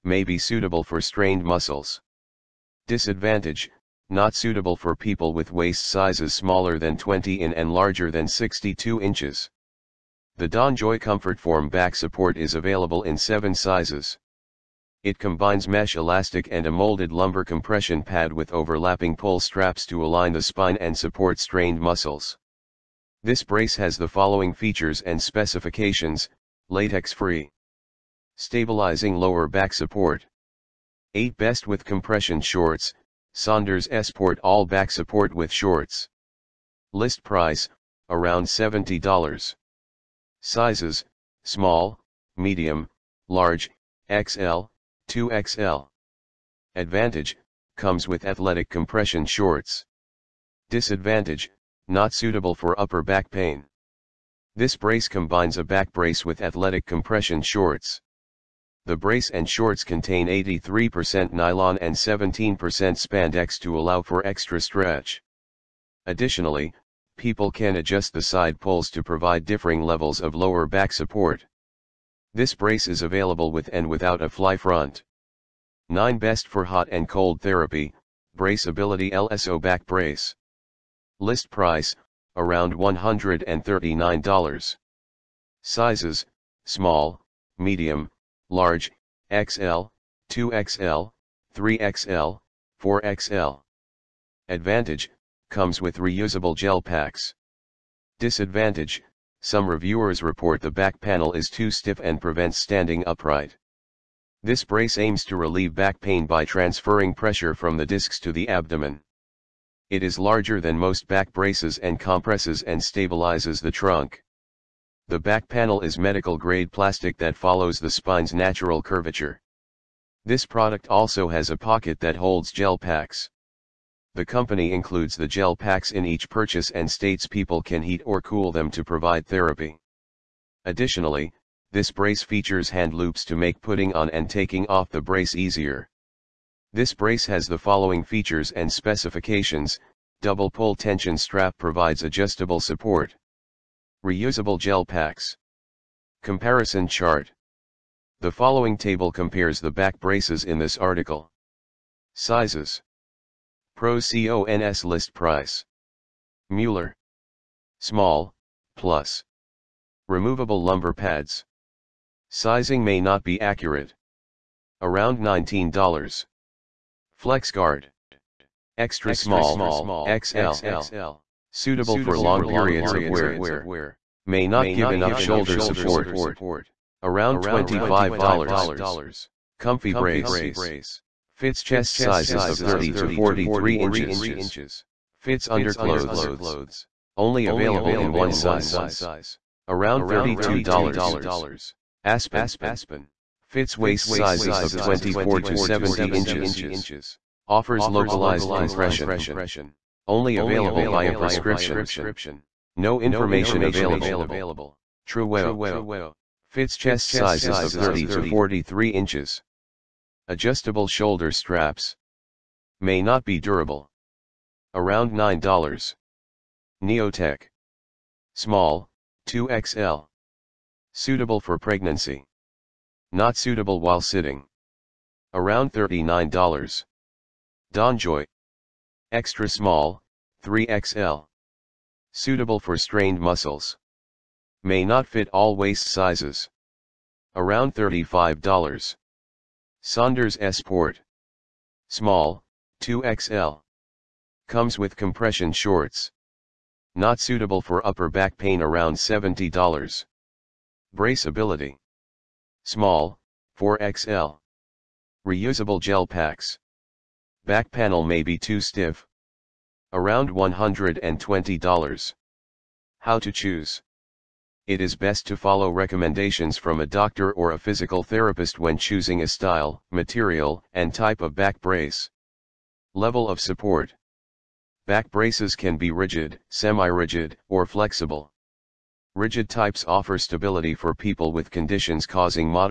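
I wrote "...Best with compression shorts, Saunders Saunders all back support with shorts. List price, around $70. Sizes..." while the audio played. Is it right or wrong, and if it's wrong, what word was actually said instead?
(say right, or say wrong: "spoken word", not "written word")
wrong: "Sport", not "Saunders".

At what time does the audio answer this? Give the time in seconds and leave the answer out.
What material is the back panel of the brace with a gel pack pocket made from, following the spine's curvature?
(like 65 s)
115 s.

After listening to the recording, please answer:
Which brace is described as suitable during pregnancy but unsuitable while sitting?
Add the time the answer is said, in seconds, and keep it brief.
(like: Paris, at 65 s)
Neotech, at 216 s.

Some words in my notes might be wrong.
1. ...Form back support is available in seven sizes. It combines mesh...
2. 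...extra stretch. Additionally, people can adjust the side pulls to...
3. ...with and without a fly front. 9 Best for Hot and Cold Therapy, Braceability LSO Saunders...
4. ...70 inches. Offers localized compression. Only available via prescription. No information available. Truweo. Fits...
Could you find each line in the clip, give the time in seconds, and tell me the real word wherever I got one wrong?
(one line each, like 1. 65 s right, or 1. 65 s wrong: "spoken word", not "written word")
1. 11 s right
2. 64 s right
3. 73 s wrong: "Back", not "Saunders"
4. 195 s right.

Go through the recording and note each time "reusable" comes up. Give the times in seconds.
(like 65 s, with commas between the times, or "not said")
95 s, 144 s, 255 s.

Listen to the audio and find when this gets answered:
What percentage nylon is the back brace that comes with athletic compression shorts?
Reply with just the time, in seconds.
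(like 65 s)
60 s.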